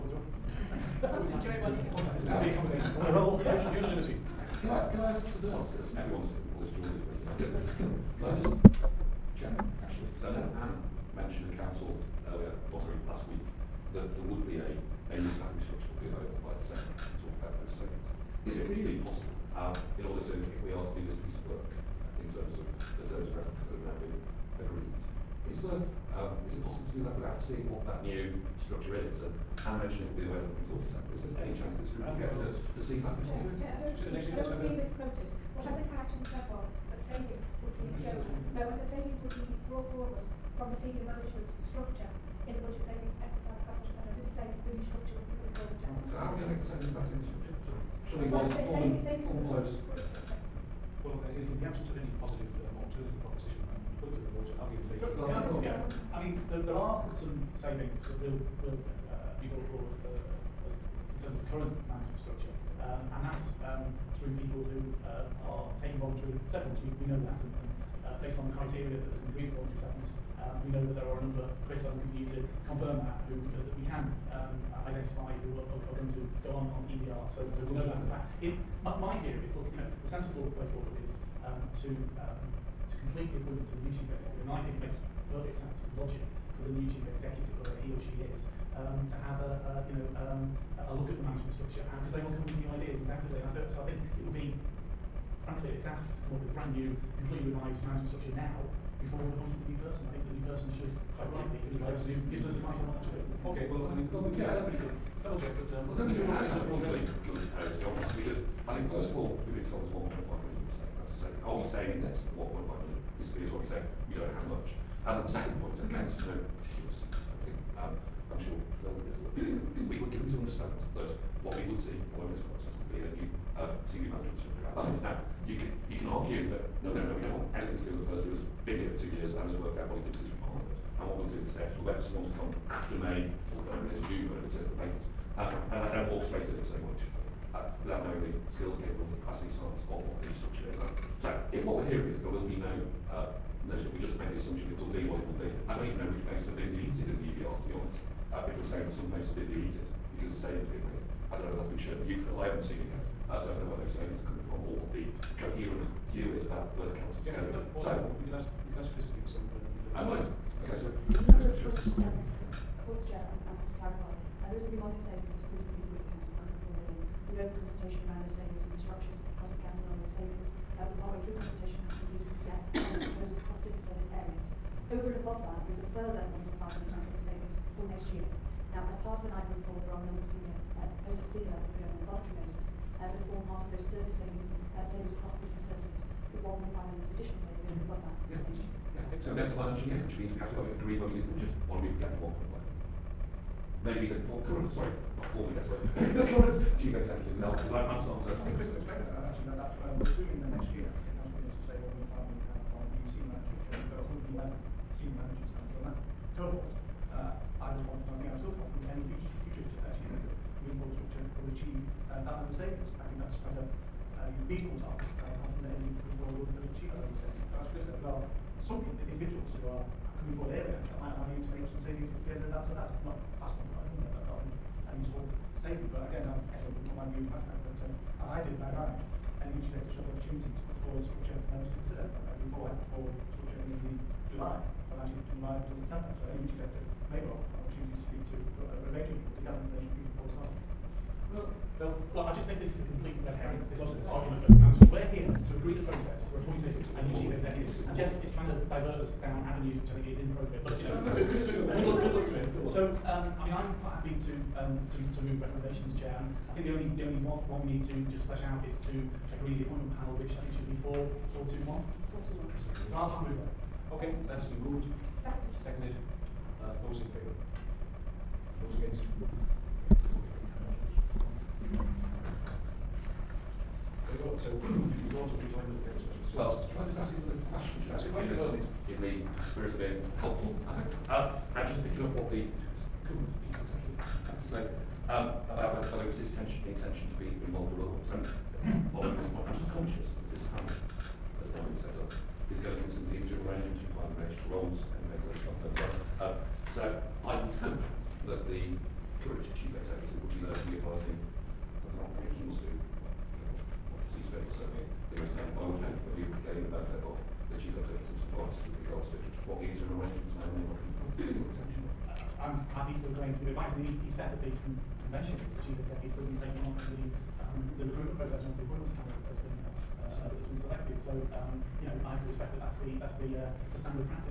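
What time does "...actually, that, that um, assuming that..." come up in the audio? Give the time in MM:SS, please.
03:19.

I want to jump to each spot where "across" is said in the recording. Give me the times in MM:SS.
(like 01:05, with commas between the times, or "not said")
02:49, 02:53, 03:05.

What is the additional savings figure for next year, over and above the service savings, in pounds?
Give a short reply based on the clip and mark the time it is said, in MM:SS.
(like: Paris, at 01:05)
1.5 million, at 02:56.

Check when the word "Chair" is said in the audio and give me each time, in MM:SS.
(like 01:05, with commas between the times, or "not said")
00:33, 00:45, 04:15.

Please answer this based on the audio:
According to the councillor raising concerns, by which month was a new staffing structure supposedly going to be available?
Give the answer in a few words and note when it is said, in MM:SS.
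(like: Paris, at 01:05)
December, at 00:16.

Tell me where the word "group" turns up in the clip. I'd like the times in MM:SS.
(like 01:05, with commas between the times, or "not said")
00:31, 02:45.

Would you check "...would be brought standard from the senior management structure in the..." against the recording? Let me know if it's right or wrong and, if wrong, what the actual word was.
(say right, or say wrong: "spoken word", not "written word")
wrong: "forward", not "standard".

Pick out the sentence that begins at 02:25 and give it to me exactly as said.
I don't even know which posts have been deleted in the EVR, to be honest.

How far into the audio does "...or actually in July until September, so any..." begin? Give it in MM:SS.
03:54.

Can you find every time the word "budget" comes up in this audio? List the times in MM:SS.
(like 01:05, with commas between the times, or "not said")
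00:42, 03:11.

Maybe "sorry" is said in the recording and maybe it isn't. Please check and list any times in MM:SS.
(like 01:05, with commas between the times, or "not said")
00:12, 03:14.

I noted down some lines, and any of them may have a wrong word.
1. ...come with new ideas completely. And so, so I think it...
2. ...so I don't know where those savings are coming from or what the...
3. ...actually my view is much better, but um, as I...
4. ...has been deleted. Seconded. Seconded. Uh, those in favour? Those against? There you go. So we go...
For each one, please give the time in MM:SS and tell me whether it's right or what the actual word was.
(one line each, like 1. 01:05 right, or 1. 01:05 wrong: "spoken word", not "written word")
1. 01:32 wrong: "undoubtedly", not "completely"
2. 02:33 right
3. 03:46 right
4. 04:24 wrong: "moved", not "deleted".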